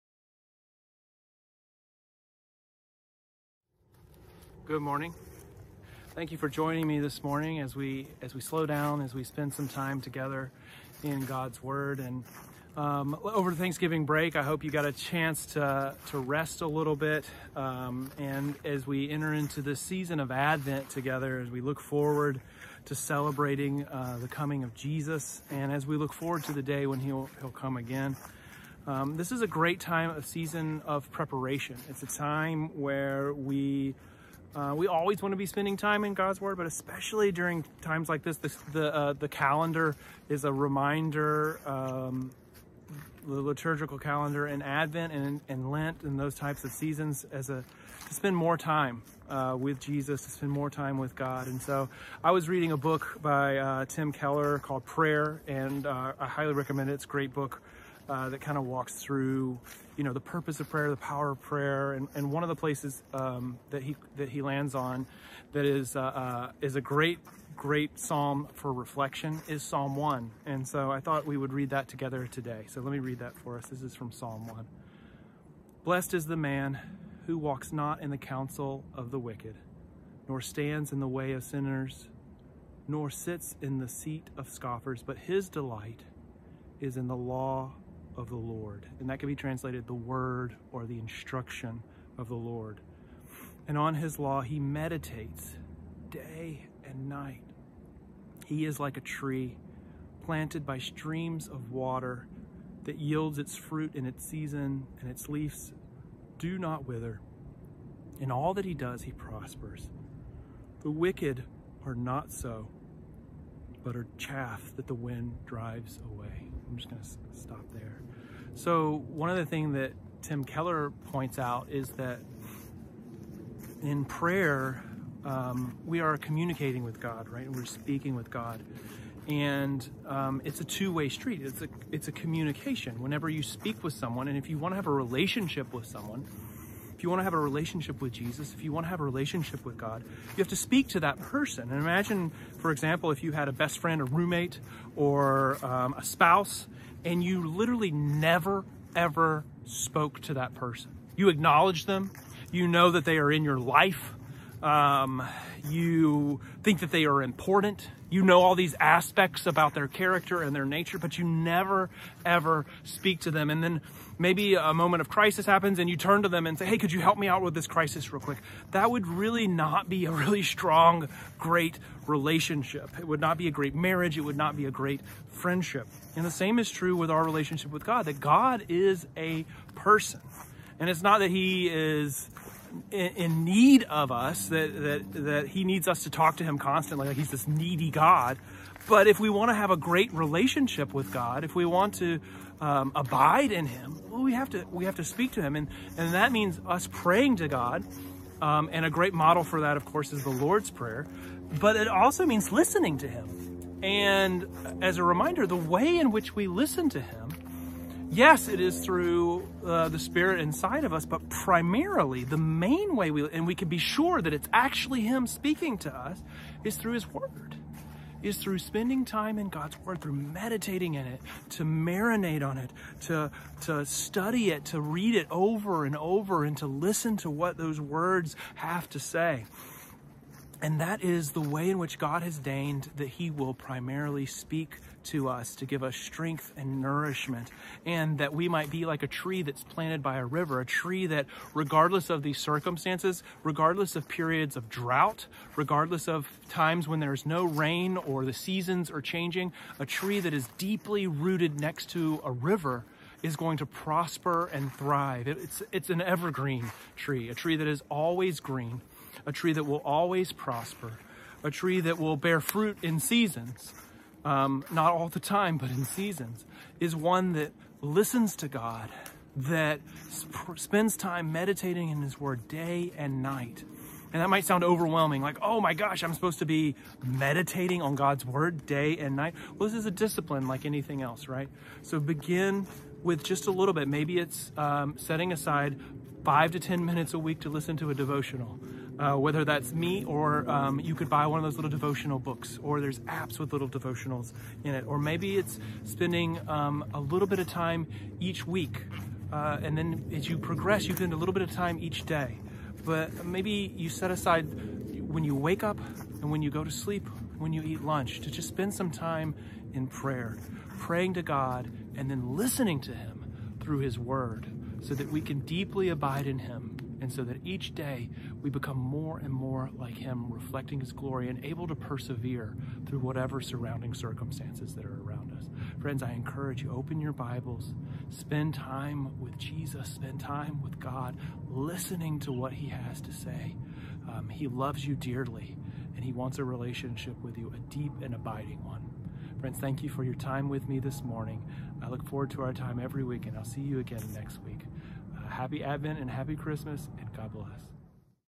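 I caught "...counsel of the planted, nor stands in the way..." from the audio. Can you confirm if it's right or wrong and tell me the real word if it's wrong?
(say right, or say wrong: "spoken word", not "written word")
wrong: "wicked", not "planted".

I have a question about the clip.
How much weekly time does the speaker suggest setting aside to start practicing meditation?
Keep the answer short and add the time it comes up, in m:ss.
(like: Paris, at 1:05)
5 to 10 minutes, at 4:46.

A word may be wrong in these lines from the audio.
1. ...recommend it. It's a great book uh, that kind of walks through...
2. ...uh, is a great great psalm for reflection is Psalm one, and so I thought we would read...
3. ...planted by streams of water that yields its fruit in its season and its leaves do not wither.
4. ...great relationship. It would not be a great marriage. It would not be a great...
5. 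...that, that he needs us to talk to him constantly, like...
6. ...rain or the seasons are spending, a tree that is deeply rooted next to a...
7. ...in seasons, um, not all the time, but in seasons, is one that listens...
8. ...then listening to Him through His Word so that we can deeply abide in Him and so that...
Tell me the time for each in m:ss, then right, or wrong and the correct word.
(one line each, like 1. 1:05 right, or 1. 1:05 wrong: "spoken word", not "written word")
1. 0:56 right
2. 1:06 right
3. 1:40 right
4. 2:51 right
5. 3:04 right
6. 4:07 wrong: "changing", not "spending"
7. 4:22 right
8. 5:12 right.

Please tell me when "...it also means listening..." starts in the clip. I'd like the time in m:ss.
3:21.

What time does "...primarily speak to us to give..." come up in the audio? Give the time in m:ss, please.
3:53.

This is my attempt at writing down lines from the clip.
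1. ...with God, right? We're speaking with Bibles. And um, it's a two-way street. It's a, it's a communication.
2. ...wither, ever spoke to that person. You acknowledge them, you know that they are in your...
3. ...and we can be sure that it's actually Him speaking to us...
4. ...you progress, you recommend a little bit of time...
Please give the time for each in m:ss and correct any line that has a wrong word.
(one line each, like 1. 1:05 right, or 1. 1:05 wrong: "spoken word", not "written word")
1. 2:06 wrong: "God", not "Bibles"
2. 2:27 wrong: "never", not "wither"
3. 3:33 right
4. 5:00 wrong: "spend", not "recommend".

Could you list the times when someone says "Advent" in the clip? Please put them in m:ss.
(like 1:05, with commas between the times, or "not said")
0:20, 0:44, 5:45.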